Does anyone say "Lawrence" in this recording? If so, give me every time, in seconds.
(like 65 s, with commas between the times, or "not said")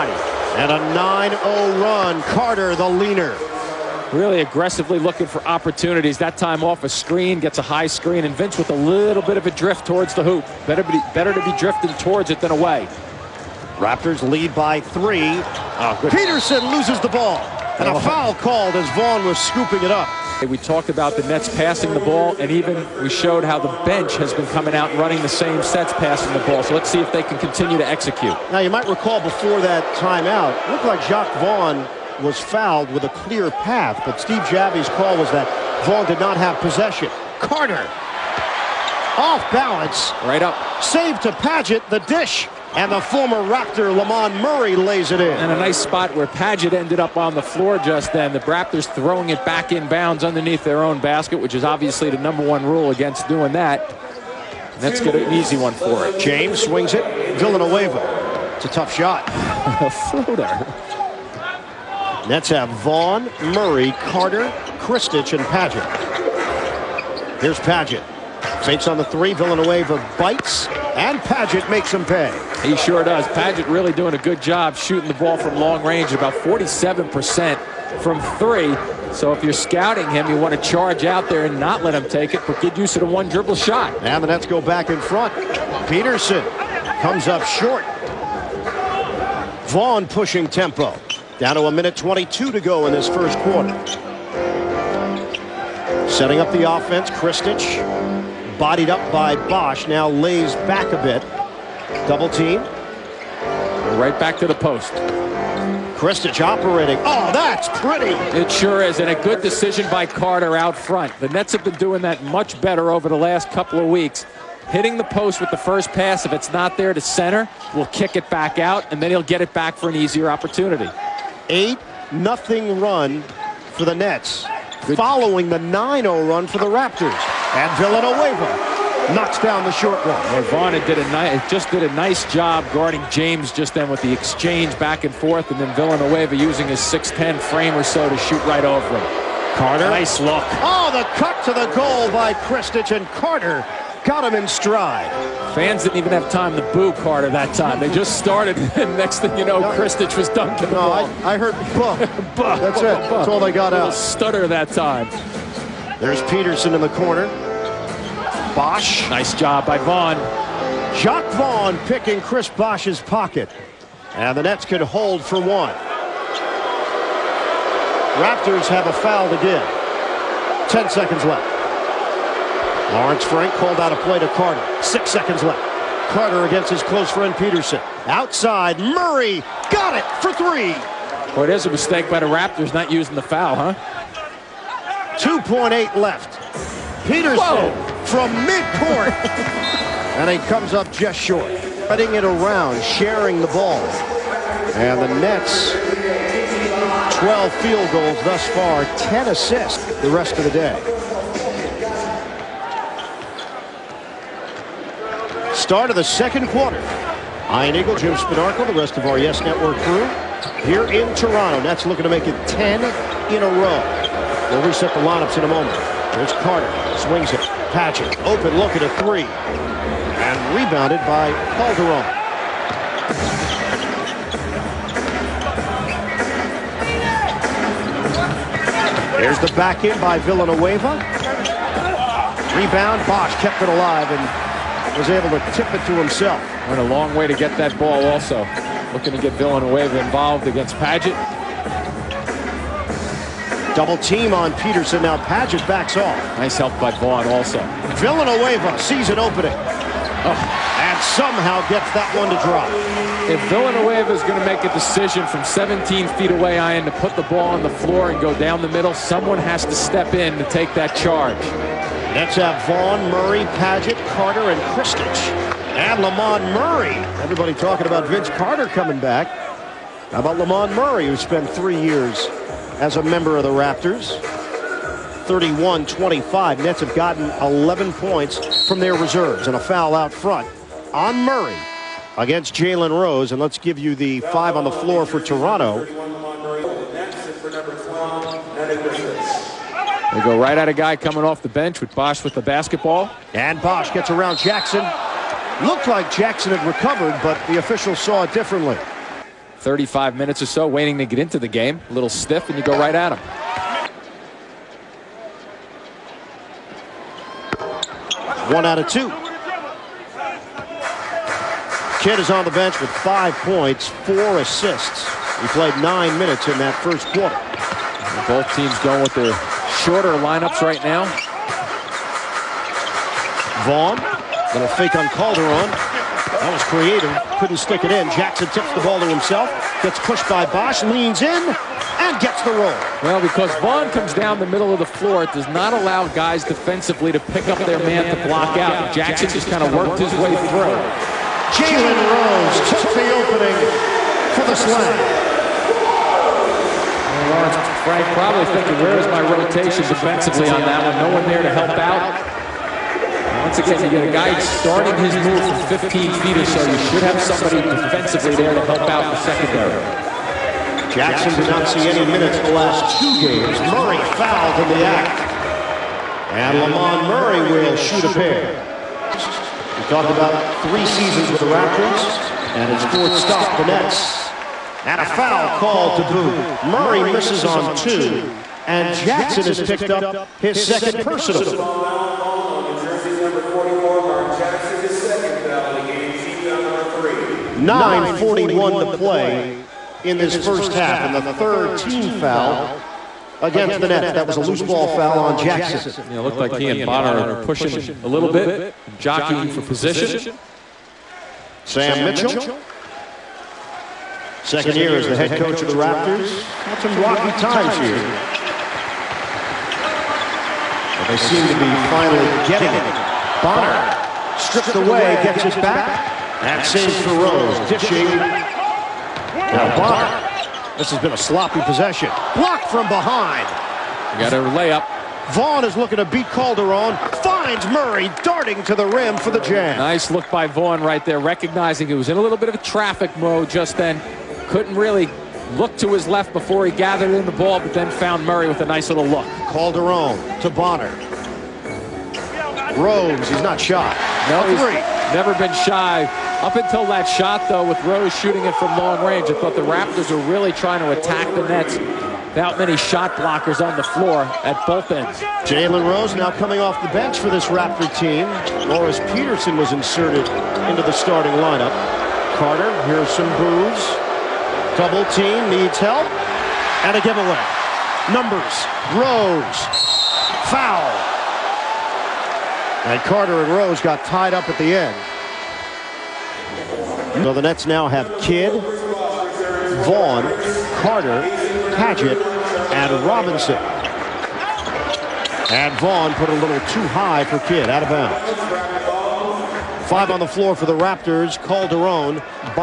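172 s, 347 s.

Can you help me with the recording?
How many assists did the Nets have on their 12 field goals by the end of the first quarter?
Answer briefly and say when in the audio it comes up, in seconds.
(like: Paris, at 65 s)
10, at 198 s.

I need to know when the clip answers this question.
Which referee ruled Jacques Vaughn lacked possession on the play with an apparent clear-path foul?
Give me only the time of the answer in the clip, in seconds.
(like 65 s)
34 s.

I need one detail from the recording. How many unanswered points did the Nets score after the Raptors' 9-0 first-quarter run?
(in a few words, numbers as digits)
8.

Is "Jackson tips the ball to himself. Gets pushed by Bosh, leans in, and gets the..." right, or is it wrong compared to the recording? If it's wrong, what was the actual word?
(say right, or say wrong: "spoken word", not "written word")
right.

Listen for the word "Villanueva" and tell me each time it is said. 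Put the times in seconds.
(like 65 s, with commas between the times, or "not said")
57 s, 69 s, 127 s, 135 s, 230 s, 239 s, 247 s, 253 s.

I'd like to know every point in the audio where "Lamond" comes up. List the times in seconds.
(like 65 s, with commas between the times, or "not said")
43 s, 265 s, 270 s, 366 s.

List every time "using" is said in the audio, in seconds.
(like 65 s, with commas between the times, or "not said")
136 s, 182 s.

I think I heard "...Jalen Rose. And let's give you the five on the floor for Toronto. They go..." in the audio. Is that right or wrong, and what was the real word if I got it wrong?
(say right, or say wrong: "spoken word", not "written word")
right.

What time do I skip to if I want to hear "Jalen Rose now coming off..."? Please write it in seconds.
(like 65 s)
455 s.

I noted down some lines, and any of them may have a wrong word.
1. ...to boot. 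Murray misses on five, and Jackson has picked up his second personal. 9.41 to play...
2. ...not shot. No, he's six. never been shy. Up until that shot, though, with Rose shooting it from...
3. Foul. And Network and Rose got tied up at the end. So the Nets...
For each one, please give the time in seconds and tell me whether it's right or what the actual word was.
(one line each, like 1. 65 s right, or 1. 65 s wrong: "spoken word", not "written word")
1. 375 s wrong: "two", not "five"
2. 443 s wrong: "three", not "six"
3. 470 s wrong: "Carter", not "Network".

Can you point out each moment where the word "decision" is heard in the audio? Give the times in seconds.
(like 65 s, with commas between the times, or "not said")
109 s, 254 s.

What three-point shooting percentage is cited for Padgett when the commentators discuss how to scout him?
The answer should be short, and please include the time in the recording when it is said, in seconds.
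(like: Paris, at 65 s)
47%, at 76 s.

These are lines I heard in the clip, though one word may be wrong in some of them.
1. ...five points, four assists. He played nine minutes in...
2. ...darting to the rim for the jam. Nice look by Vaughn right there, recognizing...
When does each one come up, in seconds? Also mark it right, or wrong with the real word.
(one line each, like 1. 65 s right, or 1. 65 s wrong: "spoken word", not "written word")
1. 312 s right
2. 428 s right.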